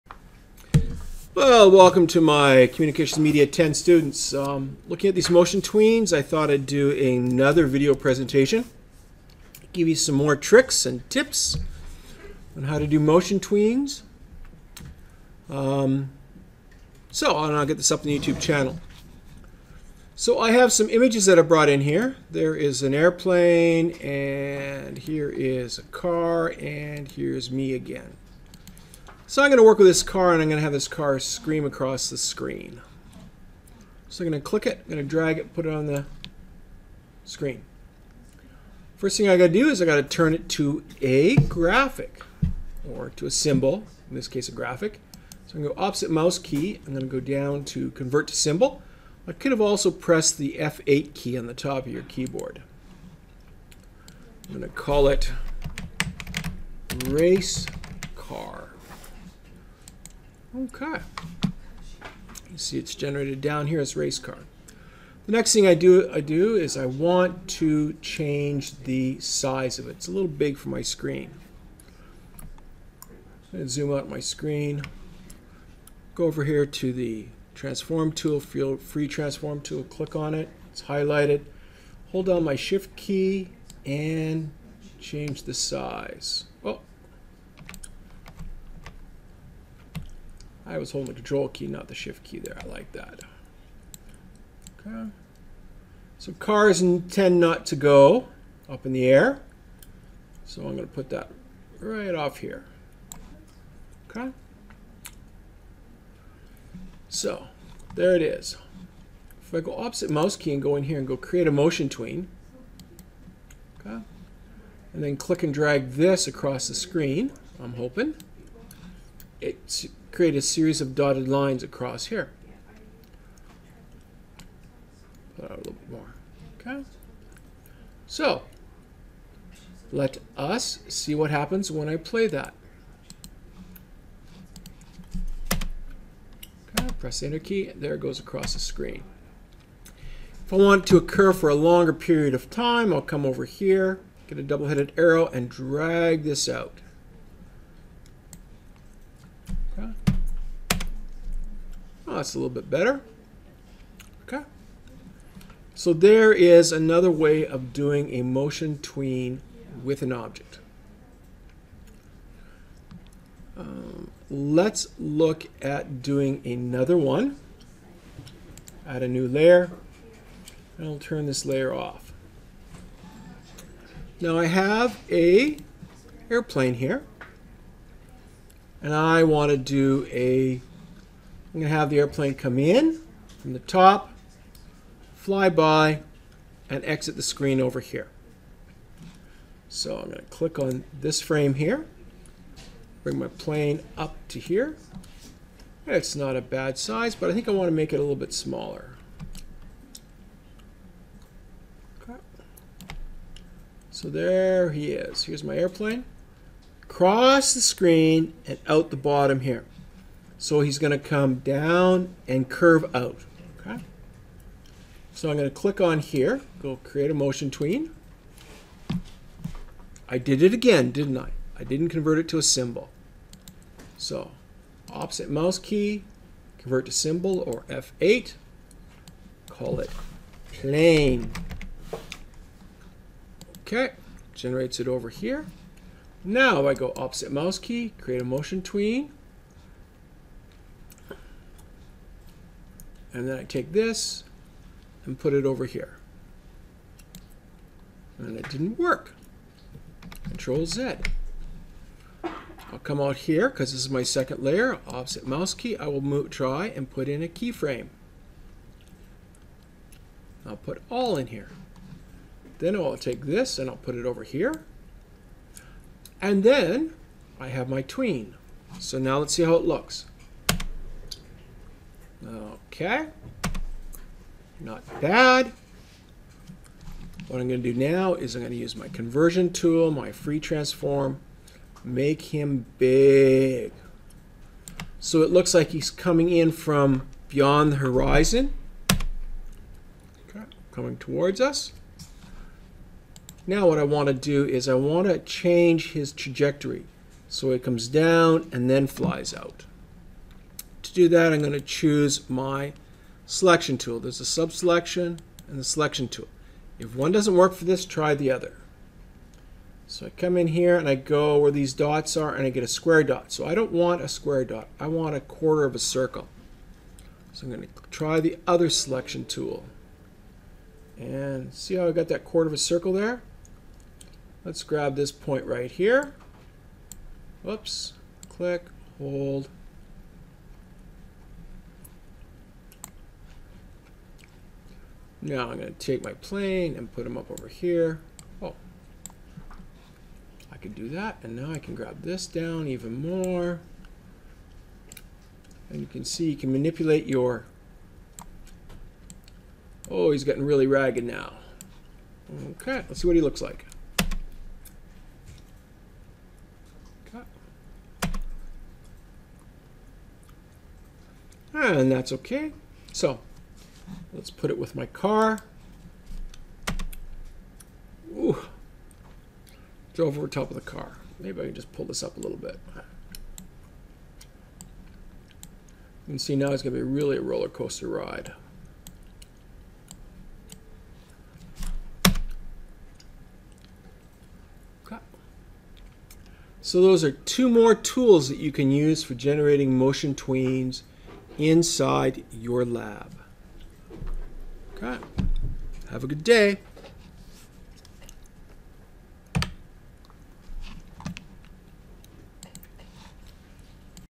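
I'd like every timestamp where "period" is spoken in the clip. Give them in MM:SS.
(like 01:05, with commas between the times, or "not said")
02:21.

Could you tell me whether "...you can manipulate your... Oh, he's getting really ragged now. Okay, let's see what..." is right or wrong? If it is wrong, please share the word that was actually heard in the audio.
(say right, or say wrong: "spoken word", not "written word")
right.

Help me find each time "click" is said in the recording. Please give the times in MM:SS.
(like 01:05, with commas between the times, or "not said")
00:34, 01:19, 01:55, 03:10, 03:35, 05:28.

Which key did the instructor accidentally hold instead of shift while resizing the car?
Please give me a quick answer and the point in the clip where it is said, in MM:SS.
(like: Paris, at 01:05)
control key, at 01:31.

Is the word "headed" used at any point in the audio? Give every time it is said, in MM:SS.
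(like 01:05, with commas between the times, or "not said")
02:24.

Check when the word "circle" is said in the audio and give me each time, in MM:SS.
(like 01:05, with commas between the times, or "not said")
05:15, 05:22.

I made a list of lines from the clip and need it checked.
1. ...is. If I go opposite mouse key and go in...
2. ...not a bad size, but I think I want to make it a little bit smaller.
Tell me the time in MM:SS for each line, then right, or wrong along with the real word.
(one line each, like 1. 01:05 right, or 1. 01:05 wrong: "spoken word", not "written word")
1. 01:48 right
2. 03:16 right.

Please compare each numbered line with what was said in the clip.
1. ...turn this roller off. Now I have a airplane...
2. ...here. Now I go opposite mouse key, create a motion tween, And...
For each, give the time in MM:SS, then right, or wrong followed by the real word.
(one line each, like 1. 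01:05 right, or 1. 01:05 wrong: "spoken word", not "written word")
1. 02:50 wrong: "layer", not "roller"
2. 03:55 right.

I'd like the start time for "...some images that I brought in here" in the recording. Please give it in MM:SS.
00:20.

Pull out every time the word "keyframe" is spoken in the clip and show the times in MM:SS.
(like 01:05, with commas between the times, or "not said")
04:17.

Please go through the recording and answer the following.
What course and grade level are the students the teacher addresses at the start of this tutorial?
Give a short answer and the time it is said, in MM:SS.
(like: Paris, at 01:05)
Communications Media 10, at 00:02.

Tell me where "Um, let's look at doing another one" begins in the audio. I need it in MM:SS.
02:43.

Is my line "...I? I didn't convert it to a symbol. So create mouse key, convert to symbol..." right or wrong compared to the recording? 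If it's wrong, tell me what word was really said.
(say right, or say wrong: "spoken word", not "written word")
wrong: "opposite", not "create".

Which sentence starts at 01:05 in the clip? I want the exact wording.
The next thing I do, I do is I want to change the size of it.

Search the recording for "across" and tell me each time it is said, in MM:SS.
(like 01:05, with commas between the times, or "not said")
00:31, 01:56, 02:01, 02:18.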